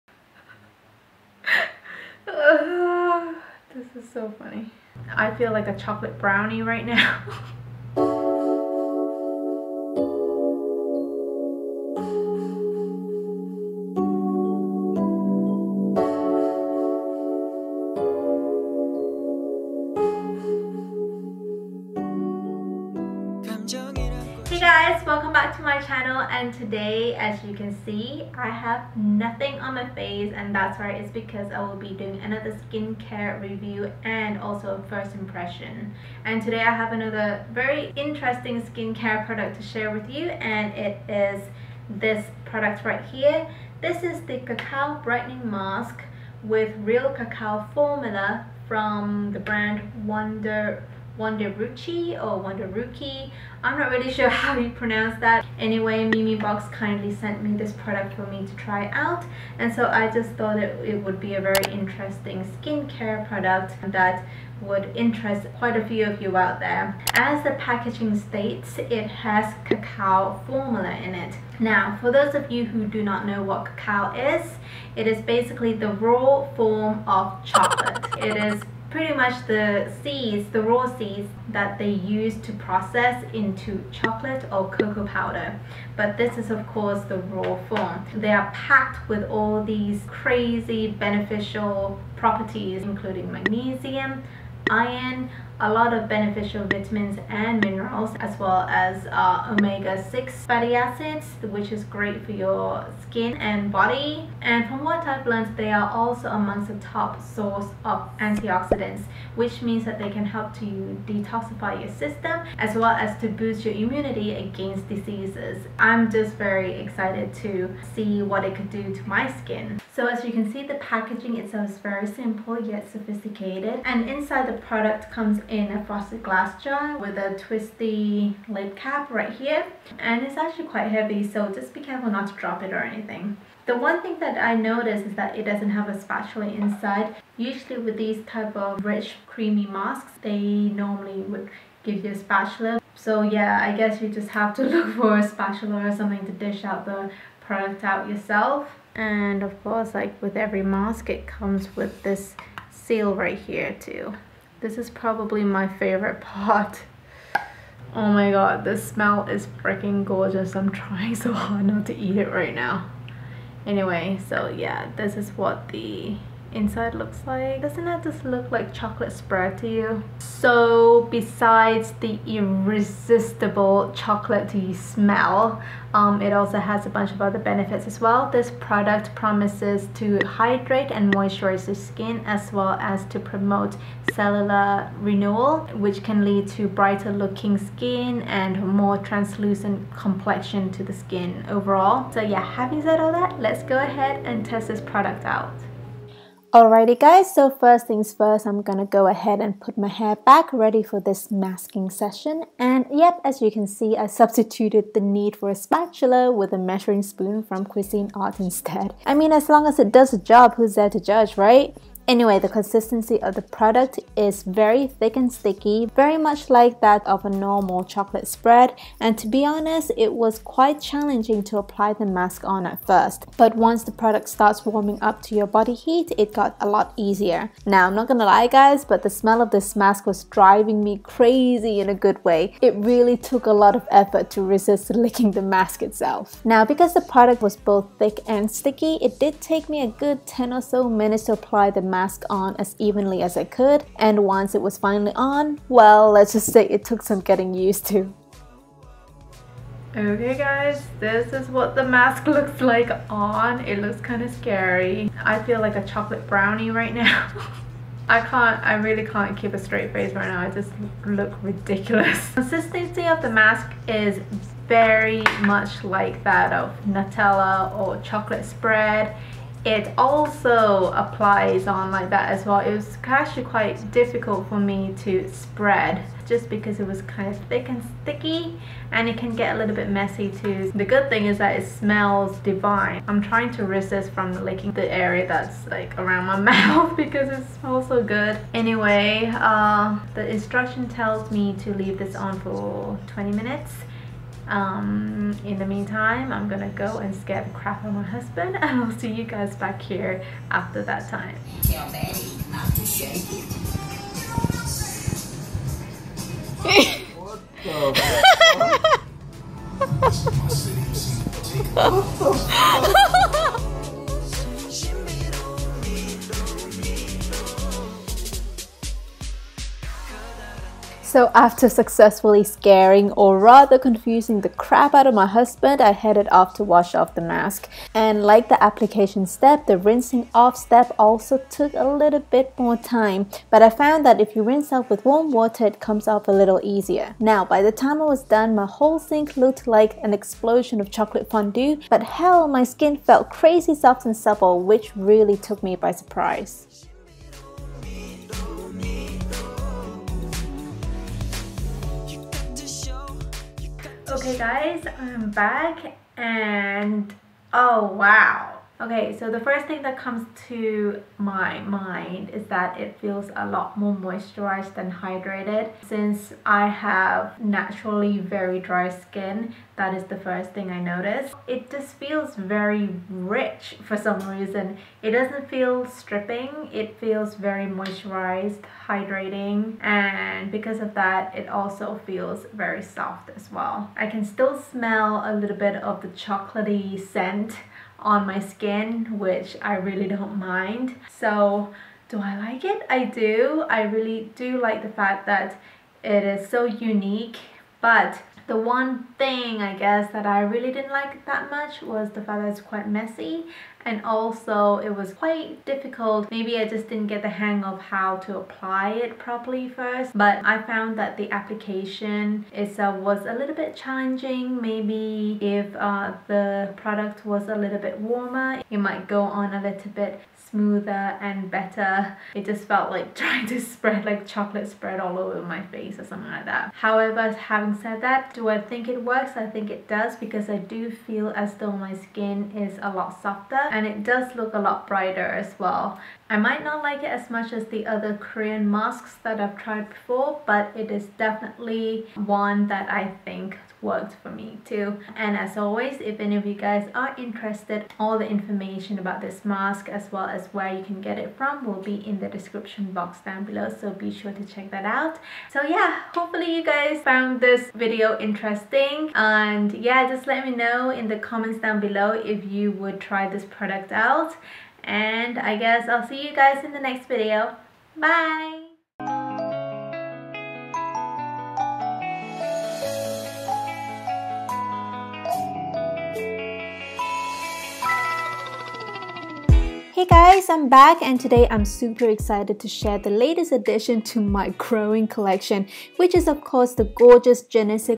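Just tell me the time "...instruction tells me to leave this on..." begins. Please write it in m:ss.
4:50.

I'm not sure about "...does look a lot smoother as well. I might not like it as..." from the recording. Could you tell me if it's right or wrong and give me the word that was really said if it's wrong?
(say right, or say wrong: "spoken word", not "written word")
wrong: "brighter", not "smoother".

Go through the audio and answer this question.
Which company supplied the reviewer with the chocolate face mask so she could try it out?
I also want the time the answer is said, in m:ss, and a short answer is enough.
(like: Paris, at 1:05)
Memebox, at 0:56.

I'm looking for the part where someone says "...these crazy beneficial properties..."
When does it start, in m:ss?
1:29.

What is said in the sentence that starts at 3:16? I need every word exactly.
Alrighty guys, so first things first, I'm gonna go ahead and put my hair back ready for this masking session.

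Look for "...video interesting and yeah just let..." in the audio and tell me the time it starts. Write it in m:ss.
7:37.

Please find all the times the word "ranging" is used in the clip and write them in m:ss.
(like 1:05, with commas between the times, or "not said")
not said.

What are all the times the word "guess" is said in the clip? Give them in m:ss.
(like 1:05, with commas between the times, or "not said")
2:23, 6:39, 7:45.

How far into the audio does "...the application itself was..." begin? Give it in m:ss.
6:51.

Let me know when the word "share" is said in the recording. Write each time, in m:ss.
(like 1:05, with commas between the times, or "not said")
0:39, 8:02.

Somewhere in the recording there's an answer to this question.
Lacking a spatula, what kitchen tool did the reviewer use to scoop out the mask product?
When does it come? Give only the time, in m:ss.
3:26.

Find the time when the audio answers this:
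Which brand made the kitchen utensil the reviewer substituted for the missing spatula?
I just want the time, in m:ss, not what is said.
3:27.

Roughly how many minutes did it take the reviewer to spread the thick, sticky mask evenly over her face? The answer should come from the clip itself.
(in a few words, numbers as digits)
10.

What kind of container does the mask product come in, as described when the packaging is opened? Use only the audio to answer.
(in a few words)
frosted glass jar.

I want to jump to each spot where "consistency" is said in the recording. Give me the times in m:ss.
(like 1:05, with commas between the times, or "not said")
3:32, 4:22.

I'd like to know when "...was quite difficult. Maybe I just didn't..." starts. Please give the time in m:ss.
6:44.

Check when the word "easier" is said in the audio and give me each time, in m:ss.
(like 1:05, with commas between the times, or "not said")
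3:46, 5:36.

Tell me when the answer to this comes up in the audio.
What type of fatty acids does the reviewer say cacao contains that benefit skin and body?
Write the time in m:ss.
1:39.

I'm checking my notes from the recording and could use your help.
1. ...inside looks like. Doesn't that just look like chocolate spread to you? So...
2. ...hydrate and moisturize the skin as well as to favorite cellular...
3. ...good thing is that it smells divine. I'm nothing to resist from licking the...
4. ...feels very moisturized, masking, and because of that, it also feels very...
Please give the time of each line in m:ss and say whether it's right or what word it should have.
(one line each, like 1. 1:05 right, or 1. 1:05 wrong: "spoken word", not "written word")
1. 2:46 right
2. 3:00 wrong: "promote", not "favorite"
3. 4:40 wrong: "trying", not "nothing"
4. 6:16 wrong: "hydrating", not "masking".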